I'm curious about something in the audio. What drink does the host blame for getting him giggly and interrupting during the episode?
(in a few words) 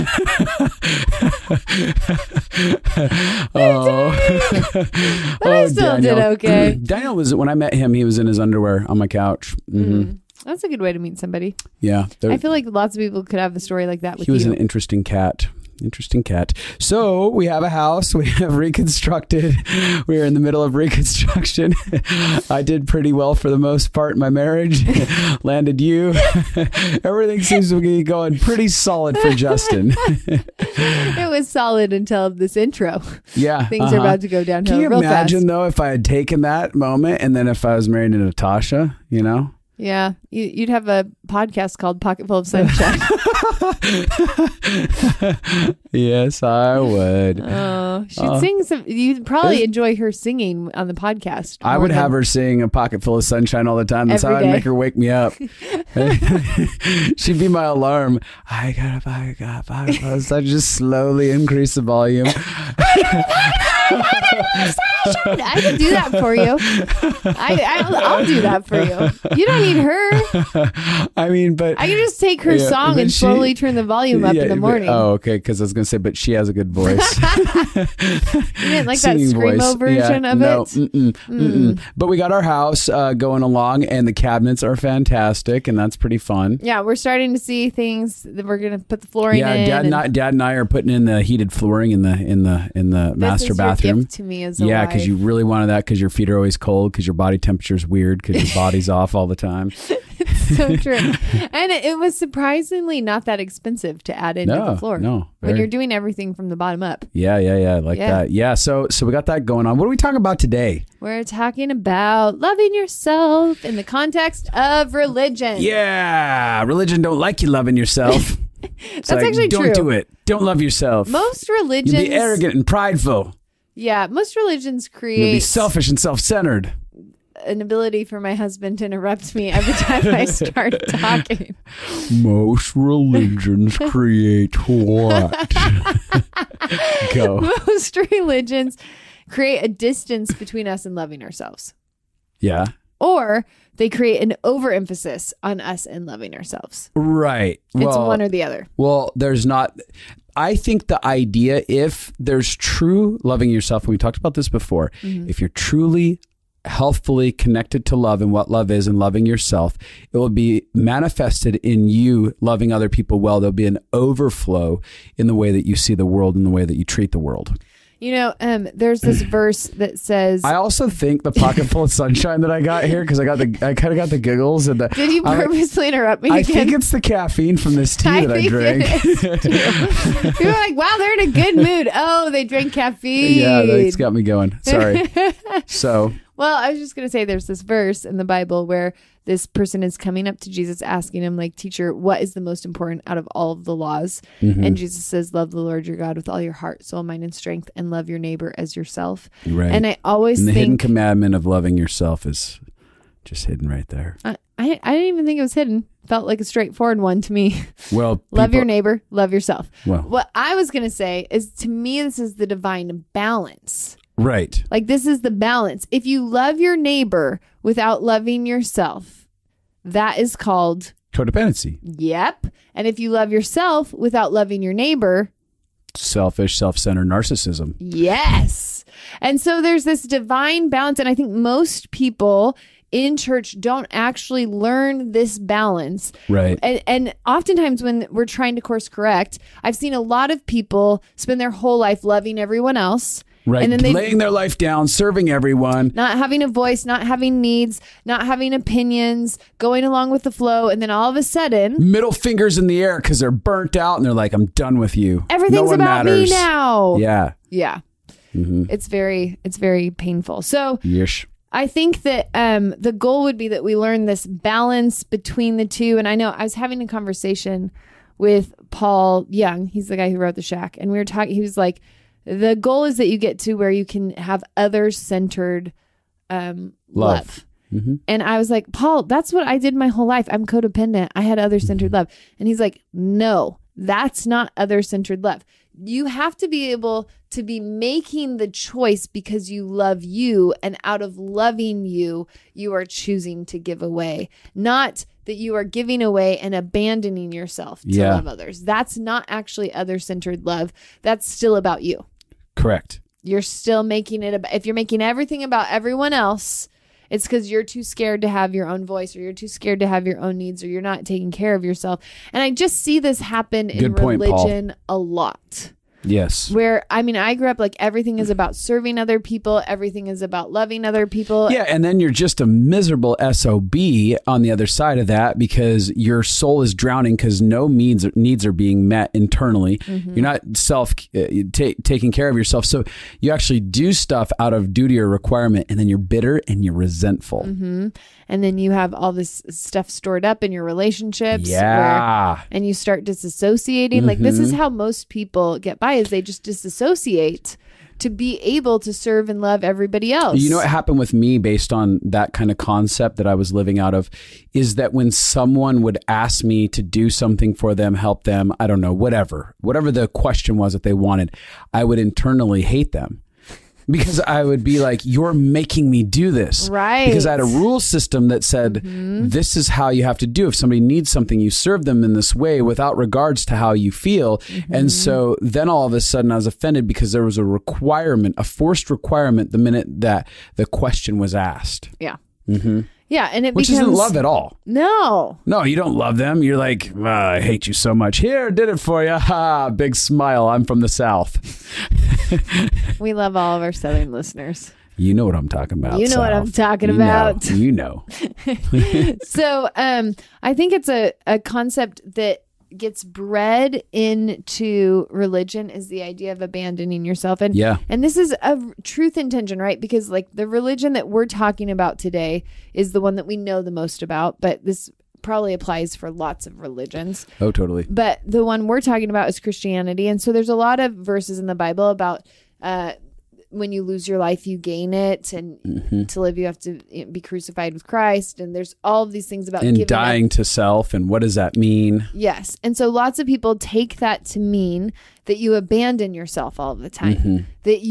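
Tea.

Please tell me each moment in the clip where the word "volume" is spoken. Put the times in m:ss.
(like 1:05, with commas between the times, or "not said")
1:01, 1:13.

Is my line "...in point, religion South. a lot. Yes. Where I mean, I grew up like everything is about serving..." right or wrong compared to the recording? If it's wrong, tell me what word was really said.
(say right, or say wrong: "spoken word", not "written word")
wrong: "Paul", not "South".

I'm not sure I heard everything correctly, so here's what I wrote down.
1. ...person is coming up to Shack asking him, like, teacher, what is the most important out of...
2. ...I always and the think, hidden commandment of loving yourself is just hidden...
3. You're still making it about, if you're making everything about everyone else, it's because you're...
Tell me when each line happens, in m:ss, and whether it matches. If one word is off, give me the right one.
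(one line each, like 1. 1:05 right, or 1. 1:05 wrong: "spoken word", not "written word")
1. 3:09 wrong: "Jesus", not "Shack"
2. 3:19 right
3. 5:03 right.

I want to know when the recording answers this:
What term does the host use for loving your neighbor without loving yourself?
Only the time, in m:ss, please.
3:41.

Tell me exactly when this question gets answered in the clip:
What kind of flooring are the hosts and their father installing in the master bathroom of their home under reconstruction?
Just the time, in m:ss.
1:31.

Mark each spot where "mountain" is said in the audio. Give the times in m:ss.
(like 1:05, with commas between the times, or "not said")
not said.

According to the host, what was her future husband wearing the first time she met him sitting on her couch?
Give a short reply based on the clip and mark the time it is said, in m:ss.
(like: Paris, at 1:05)
Underwear, at 0:08.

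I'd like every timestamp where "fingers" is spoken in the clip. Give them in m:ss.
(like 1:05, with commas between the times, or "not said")
4:12.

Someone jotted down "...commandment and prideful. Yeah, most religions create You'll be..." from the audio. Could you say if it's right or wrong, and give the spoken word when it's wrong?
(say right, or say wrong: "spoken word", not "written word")
wrong: "arrogant", not "commandment".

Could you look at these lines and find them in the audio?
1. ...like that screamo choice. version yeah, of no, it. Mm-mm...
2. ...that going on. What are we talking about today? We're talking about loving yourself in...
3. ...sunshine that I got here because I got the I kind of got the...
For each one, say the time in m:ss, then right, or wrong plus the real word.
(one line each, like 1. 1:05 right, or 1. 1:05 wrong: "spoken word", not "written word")
1. 1:18 wrong: "voice", not "choice"
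2. 1:49 right
3. 2:51 right.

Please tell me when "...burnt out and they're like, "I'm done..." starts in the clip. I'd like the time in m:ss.
4:13.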